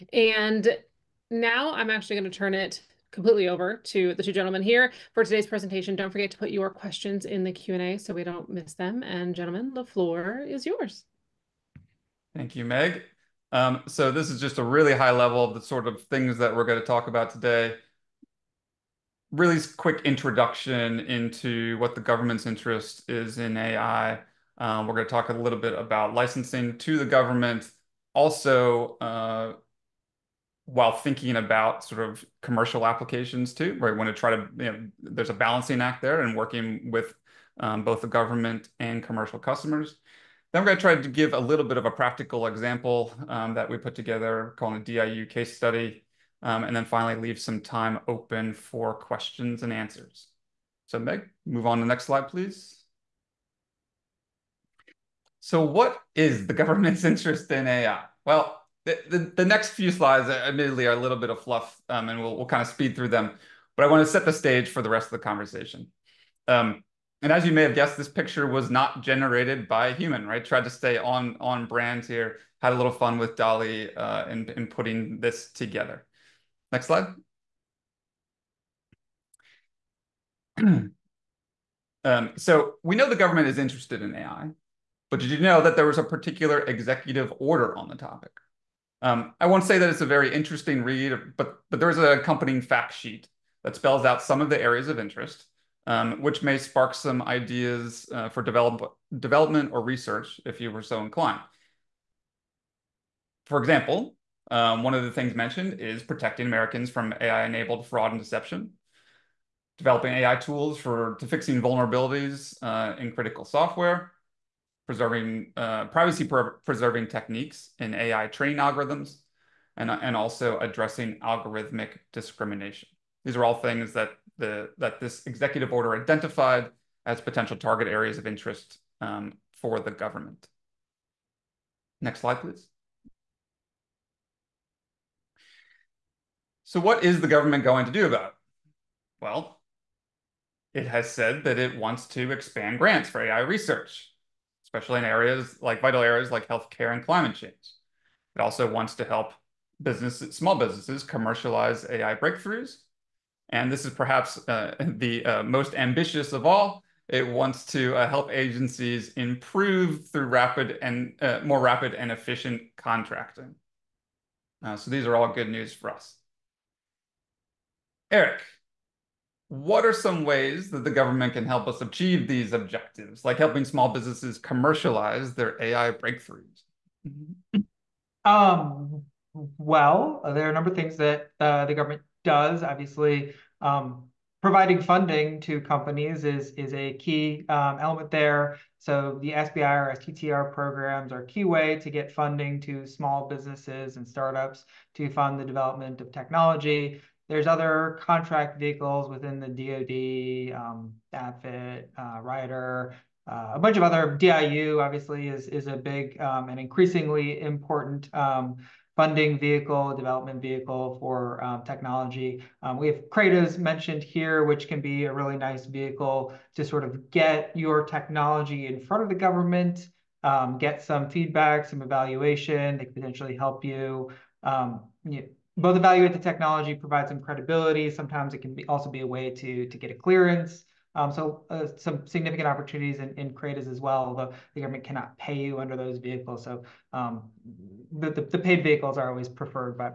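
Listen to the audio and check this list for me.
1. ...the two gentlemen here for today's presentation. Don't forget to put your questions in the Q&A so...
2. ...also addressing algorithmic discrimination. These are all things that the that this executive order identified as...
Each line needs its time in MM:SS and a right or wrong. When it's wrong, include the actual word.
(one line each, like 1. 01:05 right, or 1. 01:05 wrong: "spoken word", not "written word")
1. 00:04 right
2. 02:00 right.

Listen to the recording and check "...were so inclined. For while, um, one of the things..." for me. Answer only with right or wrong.
wrong.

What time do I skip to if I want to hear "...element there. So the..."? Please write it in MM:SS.
03:07.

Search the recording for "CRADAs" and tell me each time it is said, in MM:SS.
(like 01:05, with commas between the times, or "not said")
03:33, 03:53.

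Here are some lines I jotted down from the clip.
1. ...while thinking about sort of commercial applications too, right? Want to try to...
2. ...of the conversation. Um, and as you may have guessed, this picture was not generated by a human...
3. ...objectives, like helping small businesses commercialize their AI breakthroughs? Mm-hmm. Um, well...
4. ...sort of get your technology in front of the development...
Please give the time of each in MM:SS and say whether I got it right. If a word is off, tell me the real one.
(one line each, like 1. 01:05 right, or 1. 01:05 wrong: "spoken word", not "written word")
1. 00:30 right
2. 01:05 right
3. 02:52 right
4. 03:36 wrong: "government", not "development".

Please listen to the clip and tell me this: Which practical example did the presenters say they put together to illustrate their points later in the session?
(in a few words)
DIU case study.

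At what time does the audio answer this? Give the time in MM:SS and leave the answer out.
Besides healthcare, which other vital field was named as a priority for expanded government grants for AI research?
02:27.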